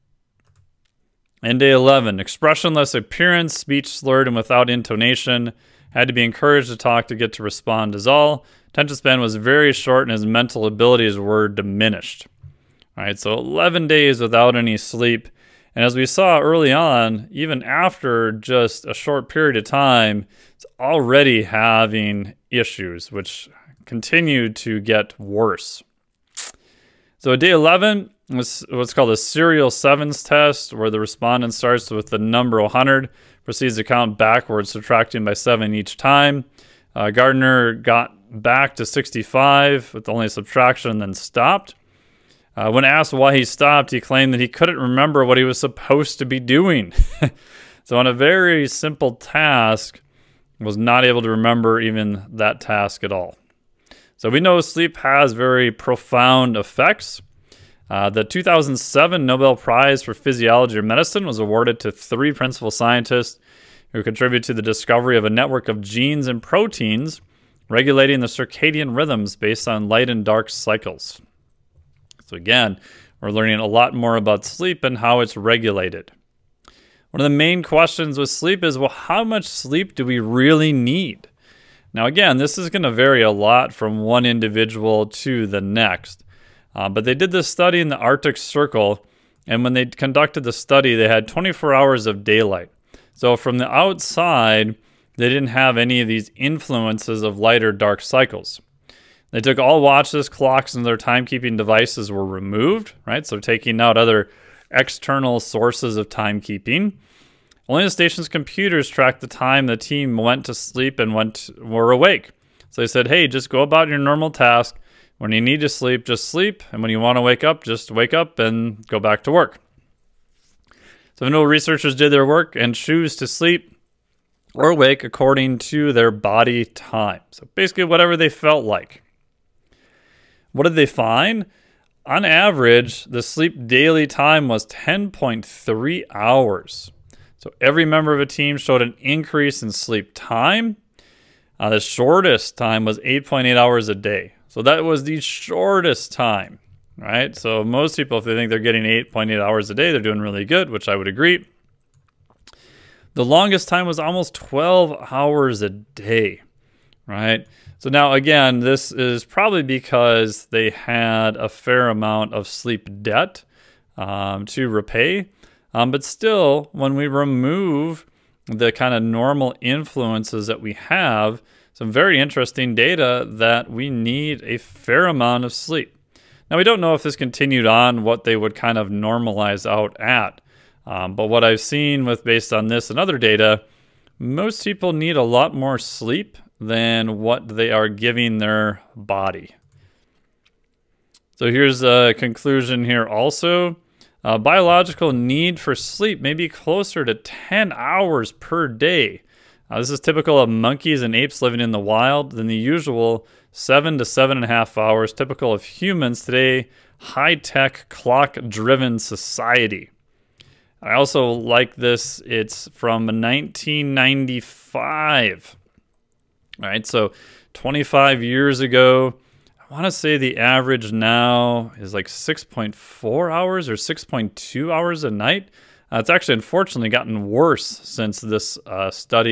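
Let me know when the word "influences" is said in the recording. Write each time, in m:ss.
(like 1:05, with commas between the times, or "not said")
1:36, 2:49.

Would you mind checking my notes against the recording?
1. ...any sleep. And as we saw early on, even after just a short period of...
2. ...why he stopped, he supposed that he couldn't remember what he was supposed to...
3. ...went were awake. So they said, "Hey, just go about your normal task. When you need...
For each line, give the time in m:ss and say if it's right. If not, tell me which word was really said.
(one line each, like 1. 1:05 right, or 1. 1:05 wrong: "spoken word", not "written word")
1. 0:14 right
2. 0:43 wrong: "claimed", not "supposed"
3. 1:51 right.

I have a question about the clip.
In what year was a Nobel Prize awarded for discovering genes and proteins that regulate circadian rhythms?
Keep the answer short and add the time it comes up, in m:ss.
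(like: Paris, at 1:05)
2007, at 0:58.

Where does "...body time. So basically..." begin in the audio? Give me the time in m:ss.
2:06.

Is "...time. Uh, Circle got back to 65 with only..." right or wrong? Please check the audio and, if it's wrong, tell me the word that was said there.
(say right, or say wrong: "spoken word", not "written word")
wrong: "Gardner", not "Circle".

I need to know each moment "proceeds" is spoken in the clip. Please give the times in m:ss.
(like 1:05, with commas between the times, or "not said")
0:33.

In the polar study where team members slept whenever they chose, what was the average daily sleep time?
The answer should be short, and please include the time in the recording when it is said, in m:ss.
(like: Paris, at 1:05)
10.3 hours, at 2:14.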